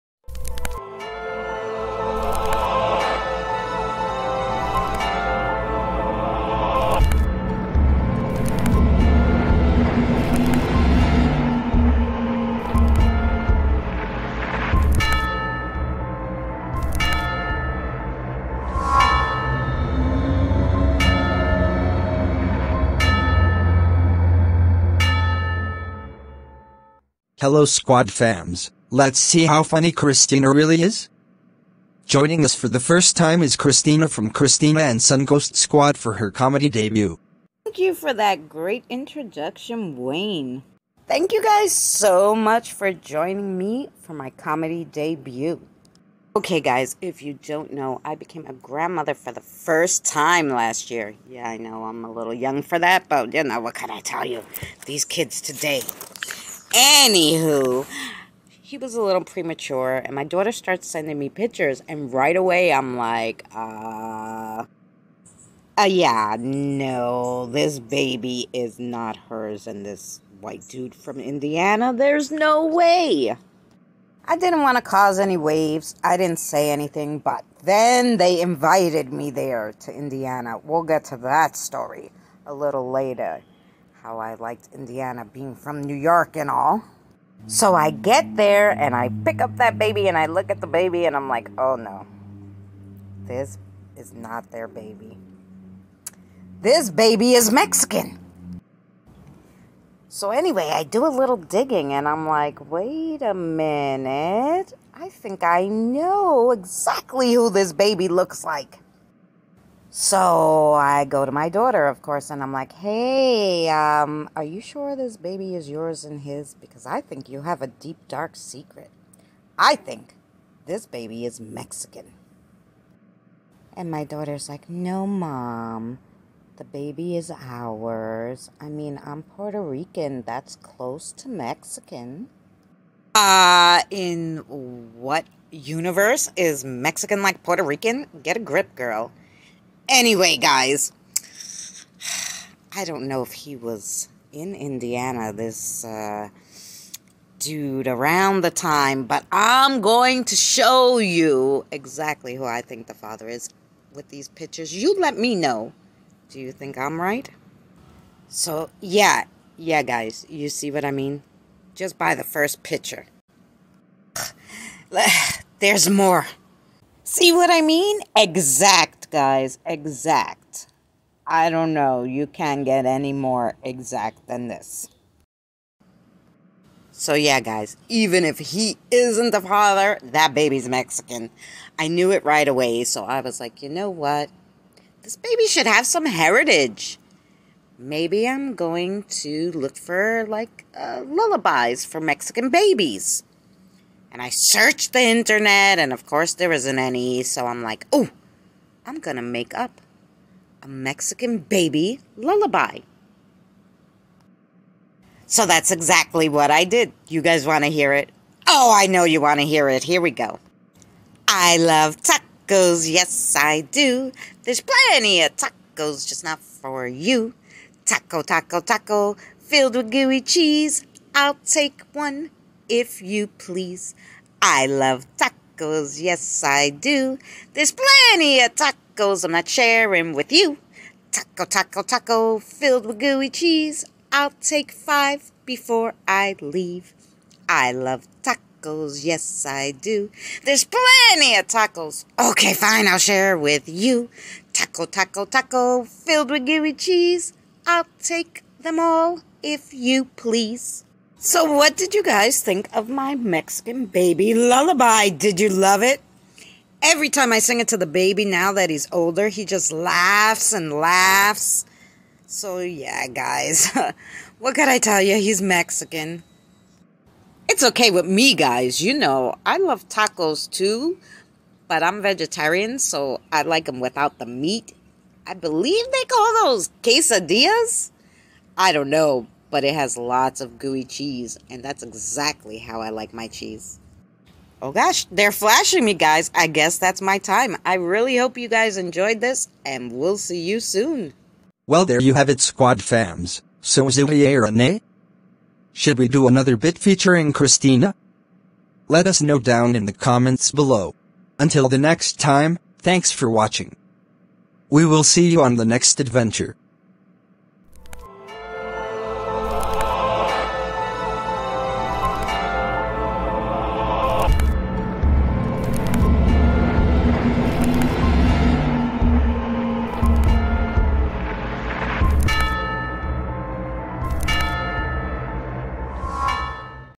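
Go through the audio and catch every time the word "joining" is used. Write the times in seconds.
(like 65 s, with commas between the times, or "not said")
32 s, 42 s.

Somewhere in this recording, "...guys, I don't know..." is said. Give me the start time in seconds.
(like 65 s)
140 s.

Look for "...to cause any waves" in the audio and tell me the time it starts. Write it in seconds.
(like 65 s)
74 s.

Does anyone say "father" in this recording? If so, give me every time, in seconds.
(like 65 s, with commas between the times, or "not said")
152 s, 179 s.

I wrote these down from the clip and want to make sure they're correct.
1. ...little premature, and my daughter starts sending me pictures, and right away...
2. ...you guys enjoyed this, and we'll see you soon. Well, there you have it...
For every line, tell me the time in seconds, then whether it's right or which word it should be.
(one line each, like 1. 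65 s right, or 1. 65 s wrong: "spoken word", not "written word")
1. 59 s right
2. 288 s right.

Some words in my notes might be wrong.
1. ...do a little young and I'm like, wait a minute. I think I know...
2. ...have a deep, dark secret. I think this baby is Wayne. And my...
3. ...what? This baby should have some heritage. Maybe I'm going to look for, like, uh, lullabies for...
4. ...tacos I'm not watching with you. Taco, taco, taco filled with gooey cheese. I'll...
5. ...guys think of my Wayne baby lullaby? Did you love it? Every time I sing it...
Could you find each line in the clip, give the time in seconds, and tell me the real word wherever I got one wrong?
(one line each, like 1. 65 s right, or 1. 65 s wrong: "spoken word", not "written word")
1. 100 s wrong: "digging", not "young"
2. 117 s wrong: "Mexican", not "Wayne"
3. 183 s right
4. 228 s wrong: "sharing", not "watching"
5. 252 s wrong: "Mexican", not "Wayne".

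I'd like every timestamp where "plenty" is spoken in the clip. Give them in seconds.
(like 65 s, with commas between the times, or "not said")
214 s, 227 s, 240 s.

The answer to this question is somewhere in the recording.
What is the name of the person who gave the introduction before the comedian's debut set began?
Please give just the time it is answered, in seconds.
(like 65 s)
39 s.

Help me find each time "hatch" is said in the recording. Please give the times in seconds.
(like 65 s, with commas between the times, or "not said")
not said.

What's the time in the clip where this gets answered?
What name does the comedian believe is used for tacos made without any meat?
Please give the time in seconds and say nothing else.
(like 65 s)
276 s.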